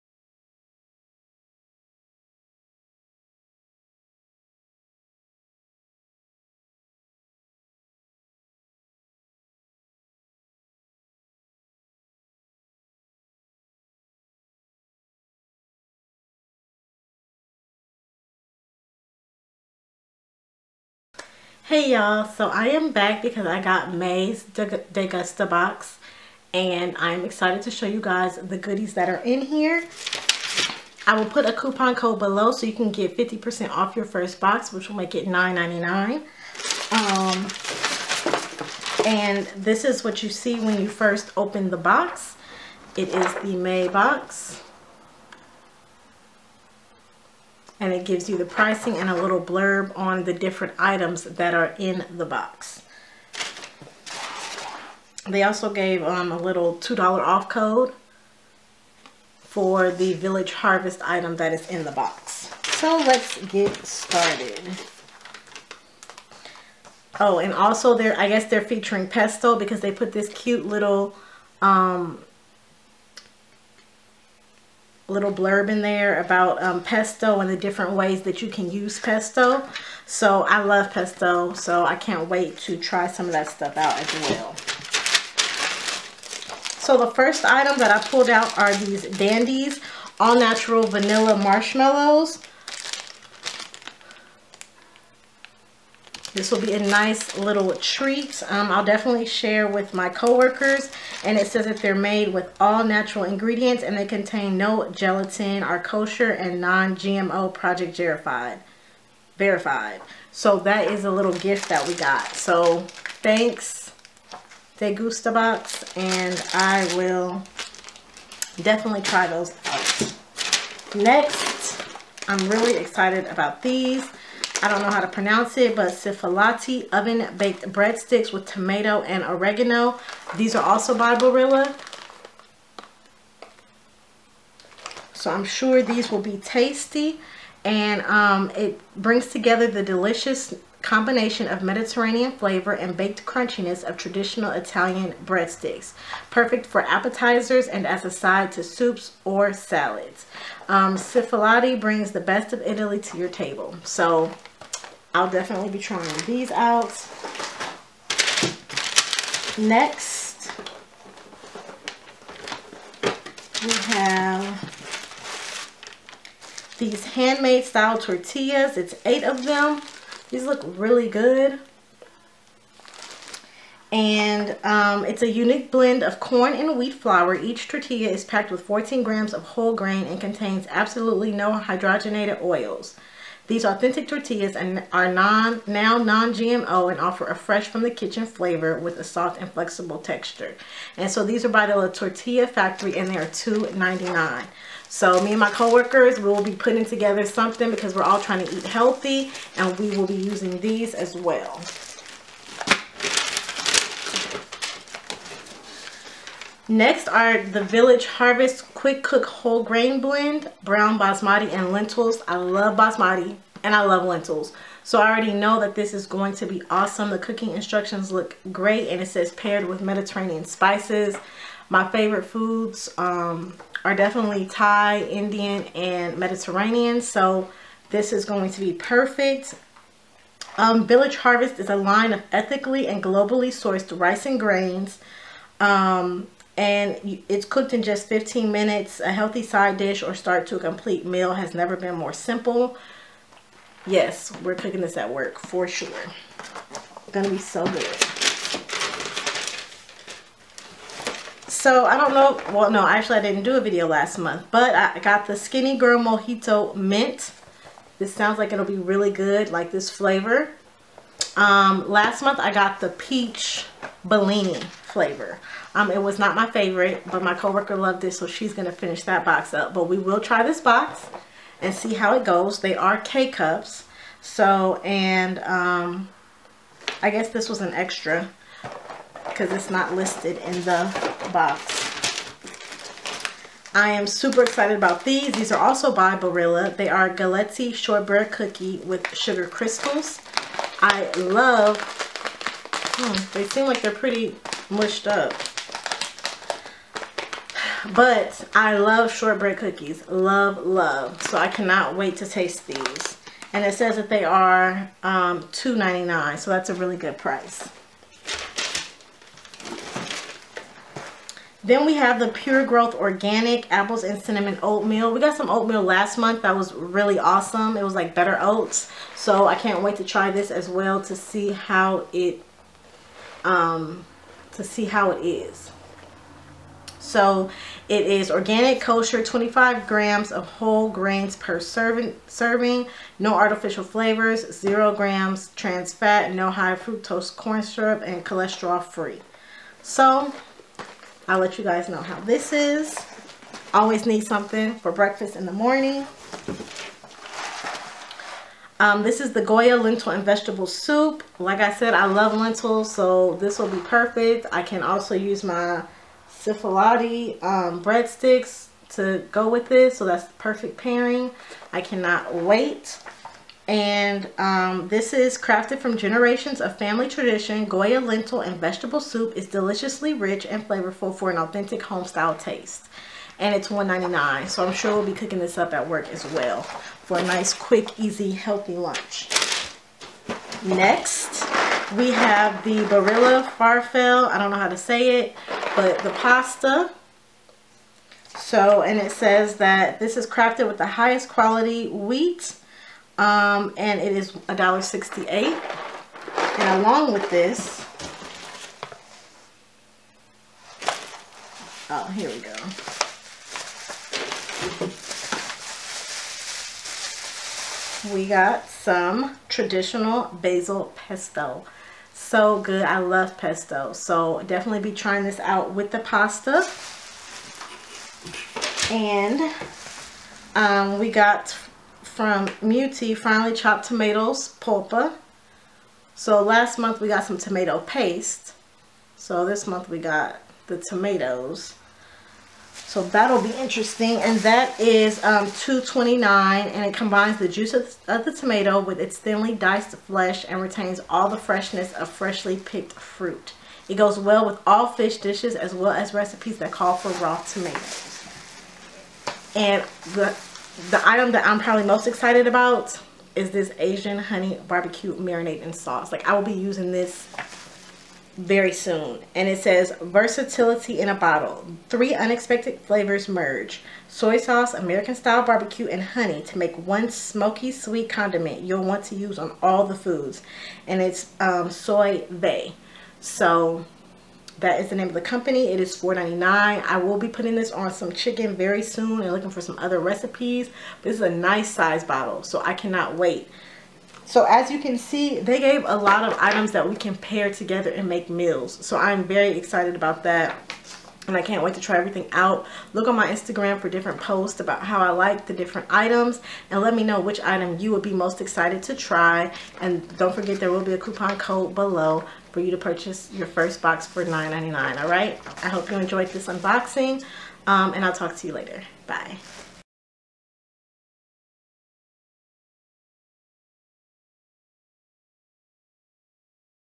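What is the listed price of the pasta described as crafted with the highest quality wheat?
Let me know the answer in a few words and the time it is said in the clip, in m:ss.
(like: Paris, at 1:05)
$1.68, at 6:34.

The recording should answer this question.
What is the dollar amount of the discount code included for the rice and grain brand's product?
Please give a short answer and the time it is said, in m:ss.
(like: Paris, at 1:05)
$2, at 0:56.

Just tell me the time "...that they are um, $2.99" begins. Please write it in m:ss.
5:03.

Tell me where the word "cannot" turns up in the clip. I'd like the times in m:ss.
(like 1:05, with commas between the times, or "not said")
5:01, 6:01, 8:02.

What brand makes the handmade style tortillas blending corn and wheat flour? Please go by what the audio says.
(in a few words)
La Tortilla Factory.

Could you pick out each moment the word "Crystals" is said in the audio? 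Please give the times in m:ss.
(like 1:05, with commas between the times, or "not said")
4:49.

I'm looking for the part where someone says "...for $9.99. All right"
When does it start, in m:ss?
8:24.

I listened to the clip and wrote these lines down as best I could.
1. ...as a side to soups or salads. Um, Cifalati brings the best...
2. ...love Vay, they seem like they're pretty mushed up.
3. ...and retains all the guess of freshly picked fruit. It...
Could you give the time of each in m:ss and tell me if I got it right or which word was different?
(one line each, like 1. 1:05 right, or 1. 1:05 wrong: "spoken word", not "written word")
1. 2:27 right
2. 4:51 wrong: "Hmm", not "Vay"
3. 7:20 wrong: "freshness", not "guess".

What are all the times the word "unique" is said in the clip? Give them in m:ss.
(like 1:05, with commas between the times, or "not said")
2:55.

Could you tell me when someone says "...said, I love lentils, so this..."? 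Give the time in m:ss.
5:51.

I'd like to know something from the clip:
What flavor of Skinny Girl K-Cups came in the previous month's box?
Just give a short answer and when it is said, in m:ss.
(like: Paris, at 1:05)
Peach Bellini, at 4:22.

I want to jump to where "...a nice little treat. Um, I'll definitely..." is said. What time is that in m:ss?
1:36.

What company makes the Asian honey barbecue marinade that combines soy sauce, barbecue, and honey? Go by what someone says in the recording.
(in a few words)
Soy Vay.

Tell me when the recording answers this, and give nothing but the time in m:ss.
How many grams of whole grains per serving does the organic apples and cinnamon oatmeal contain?
5:29.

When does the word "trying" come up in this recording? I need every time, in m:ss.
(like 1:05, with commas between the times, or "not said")
2:35, 3:18, 6:54.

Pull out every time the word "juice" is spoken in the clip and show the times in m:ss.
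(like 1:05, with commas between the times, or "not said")
7:17.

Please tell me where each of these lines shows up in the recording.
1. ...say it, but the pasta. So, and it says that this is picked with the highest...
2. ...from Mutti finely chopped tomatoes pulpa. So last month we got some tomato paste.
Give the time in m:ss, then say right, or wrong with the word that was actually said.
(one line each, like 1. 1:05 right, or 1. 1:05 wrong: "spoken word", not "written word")
1. 6:24 wrong: "crafted", not "picked"
2. 7:02 right.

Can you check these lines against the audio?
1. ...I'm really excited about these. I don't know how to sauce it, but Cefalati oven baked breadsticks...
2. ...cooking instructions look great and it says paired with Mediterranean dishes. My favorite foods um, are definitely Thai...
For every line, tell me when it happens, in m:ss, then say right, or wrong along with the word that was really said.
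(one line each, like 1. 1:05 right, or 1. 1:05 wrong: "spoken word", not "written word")
1. 2:02 wrong: "pronounce", not "sauce"
2. 3:37 wrong: "spices", not "dishes".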